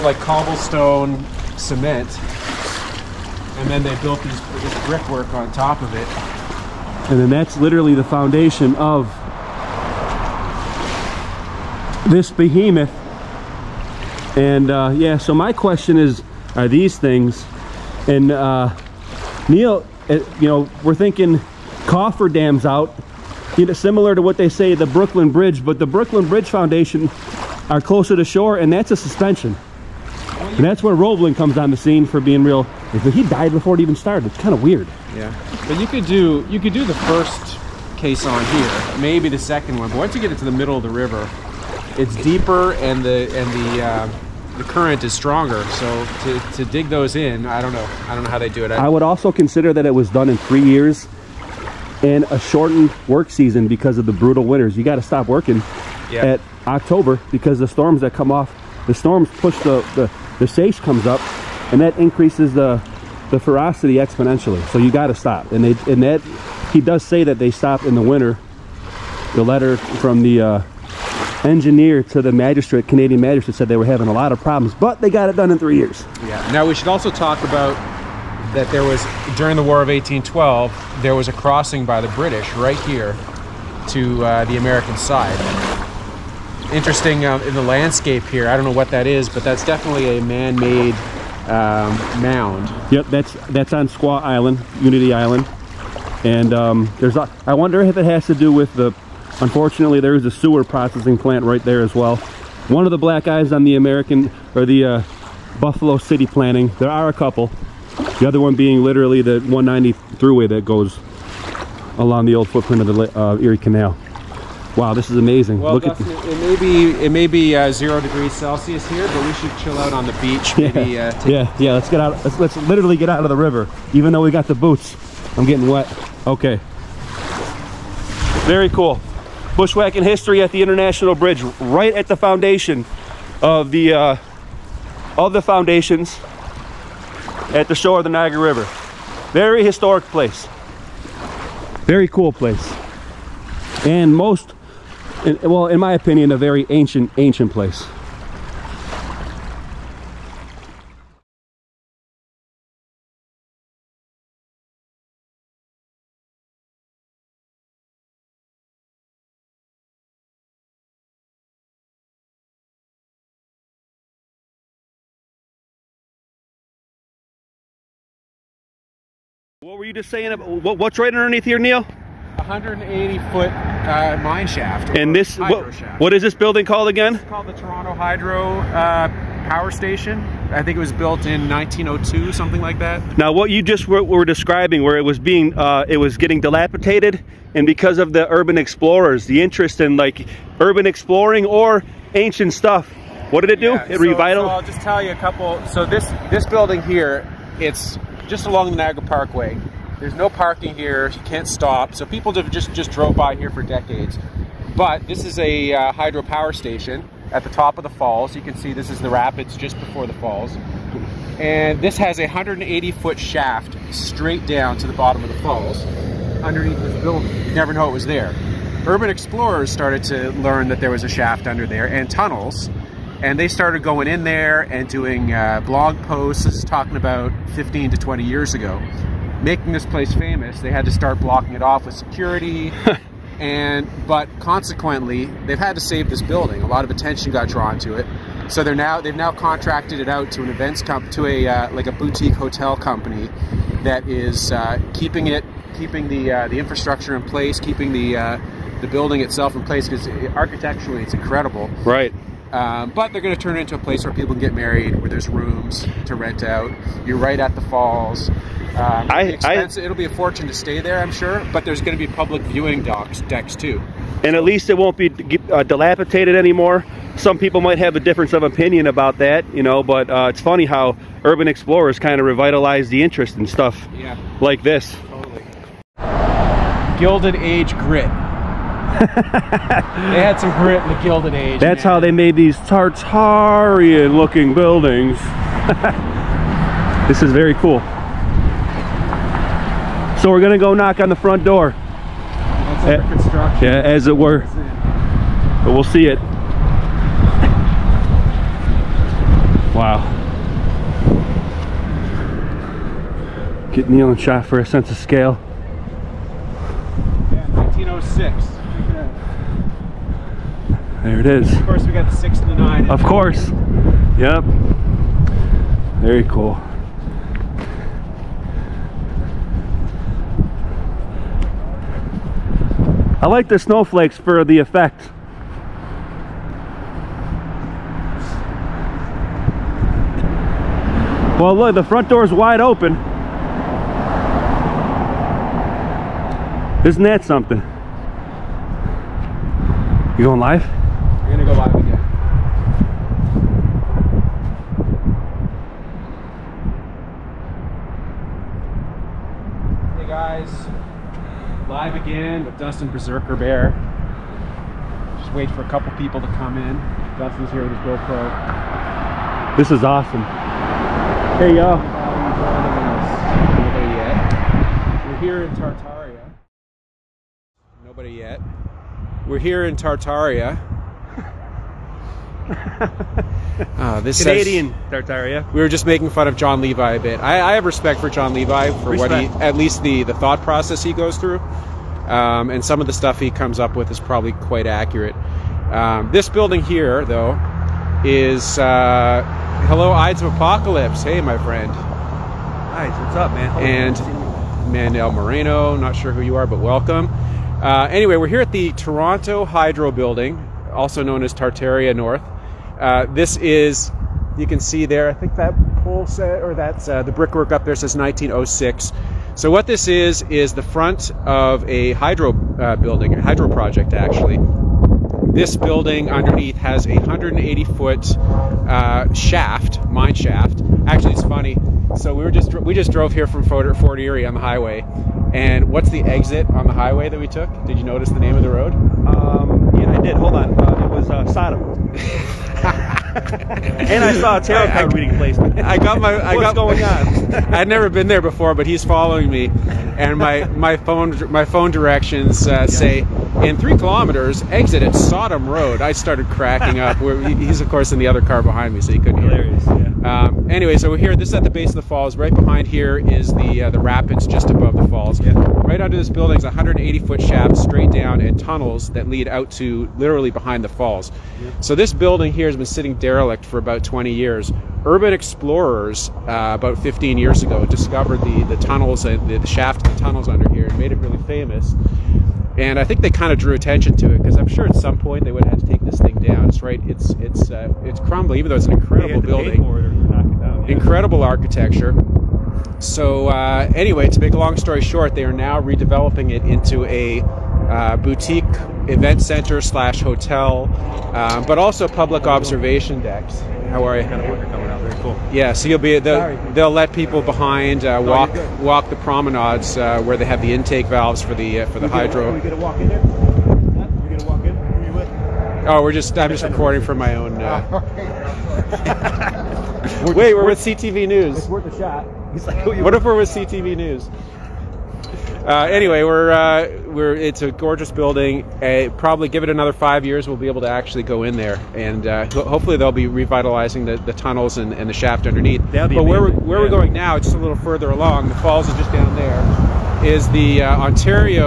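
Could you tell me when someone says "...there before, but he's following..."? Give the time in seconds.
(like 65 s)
438 s.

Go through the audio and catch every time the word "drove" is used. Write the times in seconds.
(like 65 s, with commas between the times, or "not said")
202 s, 422 s.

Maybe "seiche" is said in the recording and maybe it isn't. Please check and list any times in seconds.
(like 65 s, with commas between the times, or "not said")
60 s.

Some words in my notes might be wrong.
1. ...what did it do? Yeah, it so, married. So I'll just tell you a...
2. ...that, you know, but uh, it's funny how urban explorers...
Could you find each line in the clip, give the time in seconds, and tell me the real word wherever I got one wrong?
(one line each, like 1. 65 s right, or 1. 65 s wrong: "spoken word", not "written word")
1. 193 s wrong: "revitalized", not "married"
2. 269 s right.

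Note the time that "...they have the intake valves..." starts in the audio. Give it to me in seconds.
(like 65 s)
500 s.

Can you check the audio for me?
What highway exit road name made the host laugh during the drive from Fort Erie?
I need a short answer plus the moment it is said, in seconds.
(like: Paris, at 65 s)
Sodom Road, at 444 s.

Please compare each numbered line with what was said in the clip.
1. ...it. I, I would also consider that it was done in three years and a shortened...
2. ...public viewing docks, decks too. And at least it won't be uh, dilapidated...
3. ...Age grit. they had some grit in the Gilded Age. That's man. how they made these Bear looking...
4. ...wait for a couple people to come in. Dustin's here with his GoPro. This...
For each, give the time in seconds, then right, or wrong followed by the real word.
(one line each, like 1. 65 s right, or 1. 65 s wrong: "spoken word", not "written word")
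1. 48 s right
2. 262 s right
3. 277 s wrong: "Tartarian", not "Bear"
4. 355 s right.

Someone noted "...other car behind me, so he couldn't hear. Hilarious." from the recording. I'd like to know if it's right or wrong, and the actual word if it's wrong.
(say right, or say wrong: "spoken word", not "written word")
right.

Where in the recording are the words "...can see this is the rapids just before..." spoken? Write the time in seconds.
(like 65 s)
208 s.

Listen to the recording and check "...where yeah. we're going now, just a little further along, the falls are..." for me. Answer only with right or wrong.
right.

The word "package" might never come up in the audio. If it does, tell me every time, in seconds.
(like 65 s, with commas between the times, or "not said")
not said.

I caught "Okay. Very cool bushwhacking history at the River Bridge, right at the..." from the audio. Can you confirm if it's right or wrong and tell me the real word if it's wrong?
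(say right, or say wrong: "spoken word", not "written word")
wrong: "International", not "River".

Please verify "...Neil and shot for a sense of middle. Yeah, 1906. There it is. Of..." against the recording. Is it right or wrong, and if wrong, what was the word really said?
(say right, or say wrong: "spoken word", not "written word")
wrong: "scale", not "middle".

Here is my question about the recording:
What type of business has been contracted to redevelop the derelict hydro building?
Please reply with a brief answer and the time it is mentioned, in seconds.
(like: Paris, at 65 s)
Boutique hotel company, at 241 s.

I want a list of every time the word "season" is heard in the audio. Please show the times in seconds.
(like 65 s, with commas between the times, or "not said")
53 s.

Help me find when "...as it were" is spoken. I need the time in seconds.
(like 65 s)
293 s.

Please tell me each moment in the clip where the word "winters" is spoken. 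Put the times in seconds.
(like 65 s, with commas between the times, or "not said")
54 s, 68 s.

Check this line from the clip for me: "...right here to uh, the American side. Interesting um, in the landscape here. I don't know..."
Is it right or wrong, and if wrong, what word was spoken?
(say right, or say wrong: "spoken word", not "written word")
right.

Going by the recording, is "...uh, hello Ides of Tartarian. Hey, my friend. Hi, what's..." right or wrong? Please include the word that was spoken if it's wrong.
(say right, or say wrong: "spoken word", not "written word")
wrong: "Apocalypse", not "Tartarian".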